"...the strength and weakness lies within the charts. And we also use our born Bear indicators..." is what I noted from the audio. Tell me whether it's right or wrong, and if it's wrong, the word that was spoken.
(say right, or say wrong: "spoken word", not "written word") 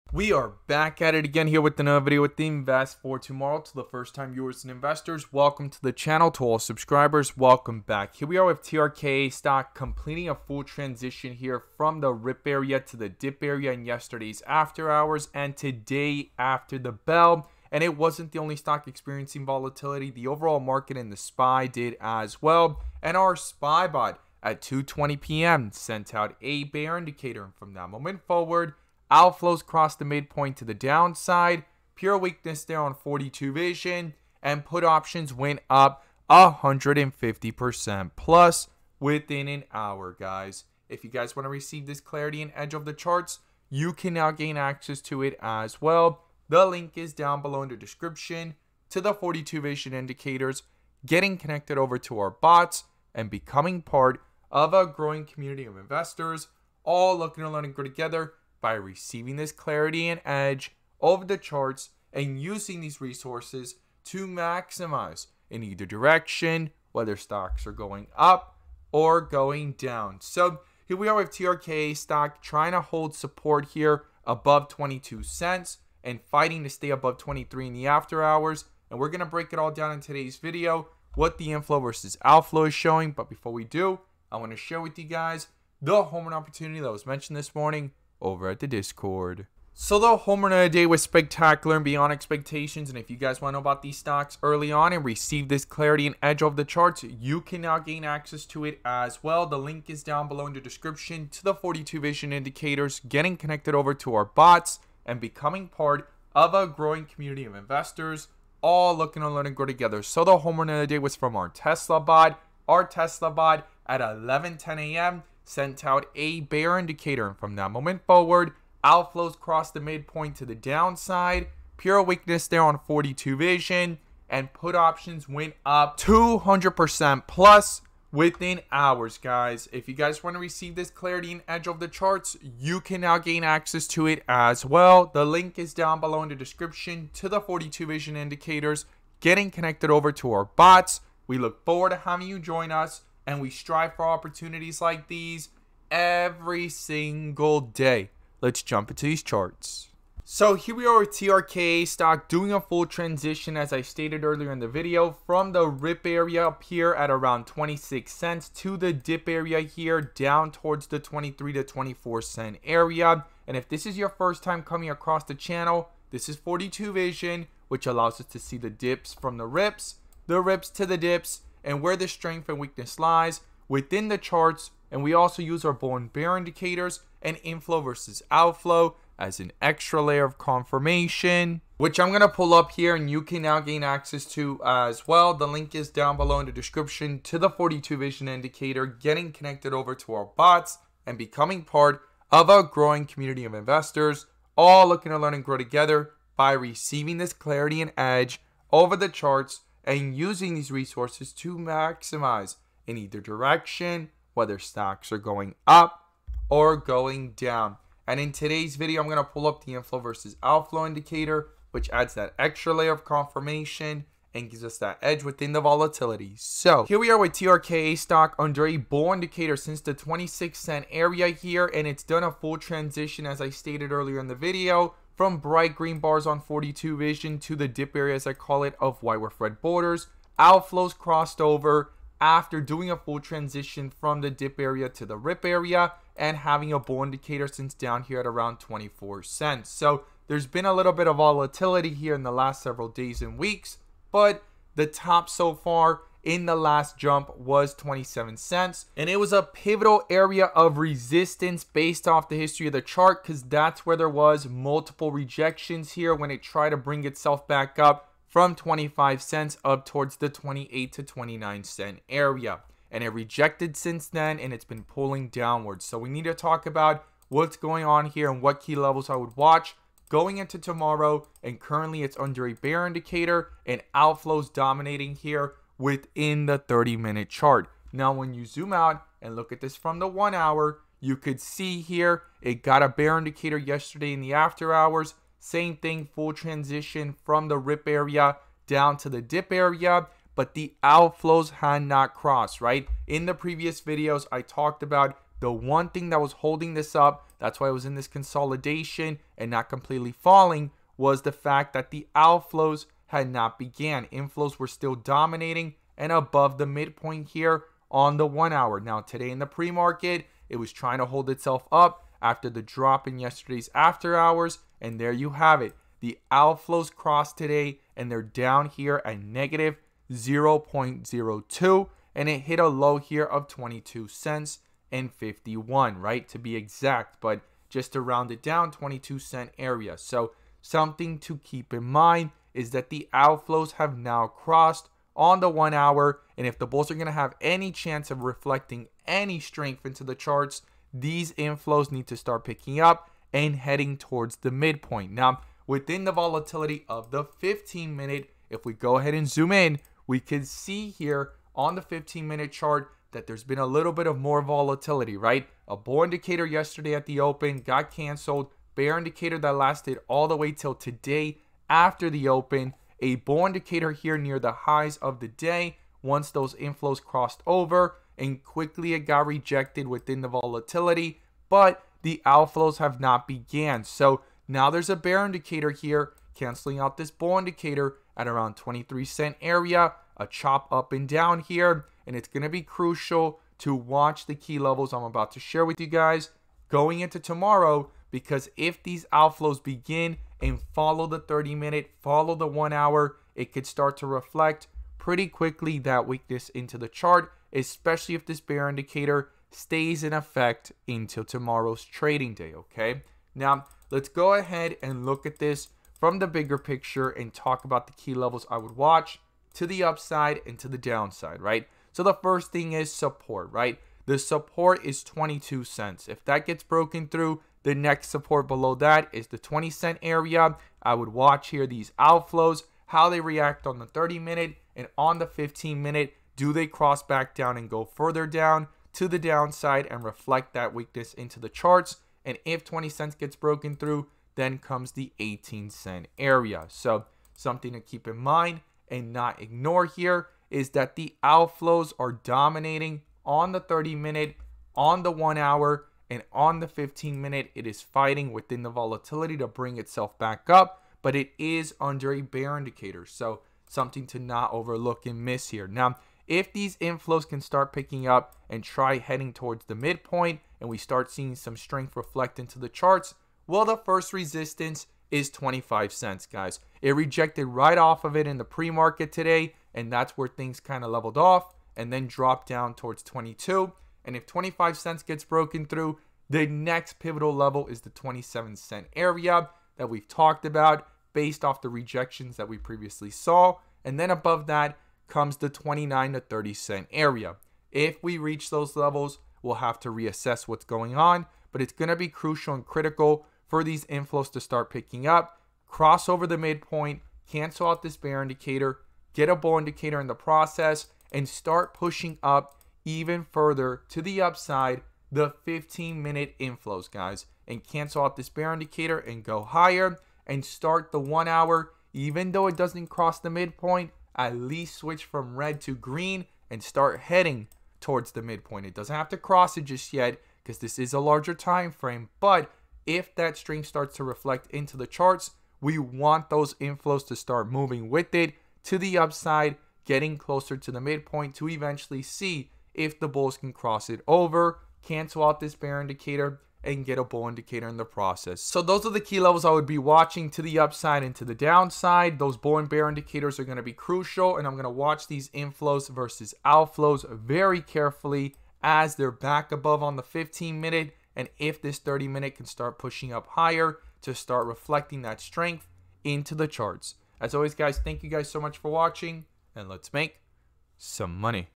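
right.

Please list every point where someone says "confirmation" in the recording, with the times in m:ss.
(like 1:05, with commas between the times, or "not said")
3:00, 3:33.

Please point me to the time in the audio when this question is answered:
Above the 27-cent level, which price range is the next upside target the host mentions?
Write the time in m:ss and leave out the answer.
8:05.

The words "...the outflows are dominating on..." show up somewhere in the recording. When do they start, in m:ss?
7:20.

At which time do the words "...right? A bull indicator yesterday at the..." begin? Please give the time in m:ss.
5:55.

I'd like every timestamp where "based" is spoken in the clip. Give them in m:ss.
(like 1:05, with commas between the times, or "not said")
4:11, 8:01.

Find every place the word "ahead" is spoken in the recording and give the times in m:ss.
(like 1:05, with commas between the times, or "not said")
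5:48, 6:44.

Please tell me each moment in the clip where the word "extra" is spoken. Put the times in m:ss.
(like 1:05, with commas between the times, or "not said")
2:59, 3:32.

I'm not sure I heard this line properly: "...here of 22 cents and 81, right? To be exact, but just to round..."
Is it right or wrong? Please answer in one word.
wrong.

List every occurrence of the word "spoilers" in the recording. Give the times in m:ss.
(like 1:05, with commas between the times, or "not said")
not said.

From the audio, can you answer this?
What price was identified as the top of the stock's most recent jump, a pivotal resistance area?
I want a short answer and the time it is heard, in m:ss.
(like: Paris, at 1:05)
27 cents, at 4:07.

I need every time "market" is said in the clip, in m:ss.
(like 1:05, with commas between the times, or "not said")
0:20, 5:09, 7:48.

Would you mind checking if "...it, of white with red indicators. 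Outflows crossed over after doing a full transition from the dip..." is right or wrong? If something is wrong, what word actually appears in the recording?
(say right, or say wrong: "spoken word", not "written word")
wrong: "borders", not "indicators".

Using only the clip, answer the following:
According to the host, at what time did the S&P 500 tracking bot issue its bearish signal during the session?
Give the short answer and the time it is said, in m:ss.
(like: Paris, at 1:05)
2:20 p.m., at 0:24.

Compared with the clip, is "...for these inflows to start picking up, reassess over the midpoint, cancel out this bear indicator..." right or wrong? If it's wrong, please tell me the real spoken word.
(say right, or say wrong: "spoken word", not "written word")
wrong: "cross", not "reassess".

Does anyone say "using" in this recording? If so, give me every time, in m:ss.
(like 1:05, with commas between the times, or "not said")
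1:02, 3:20.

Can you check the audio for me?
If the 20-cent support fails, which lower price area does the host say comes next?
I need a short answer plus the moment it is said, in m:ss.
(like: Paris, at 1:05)
18 cents, at 7:15.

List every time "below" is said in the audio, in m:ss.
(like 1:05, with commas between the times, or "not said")
0:47, 1:40, 2:15, 3:06, 6:58.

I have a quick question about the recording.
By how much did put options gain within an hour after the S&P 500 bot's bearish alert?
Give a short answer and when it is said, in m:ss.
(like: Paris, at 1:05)
150%, at 0:36.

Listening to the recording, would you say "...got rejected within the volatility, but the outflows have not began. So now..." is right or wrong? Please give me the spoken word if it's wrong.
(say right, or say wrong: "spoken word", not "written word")
right.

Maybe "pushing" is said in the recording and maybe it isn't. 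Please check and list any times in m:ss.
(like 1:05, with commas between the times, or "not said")
8:21, 9:12.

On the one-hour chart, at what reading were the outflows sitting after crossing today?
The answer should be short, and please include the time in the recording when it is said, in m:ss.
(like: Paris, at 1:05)
-0.02, at 5:19.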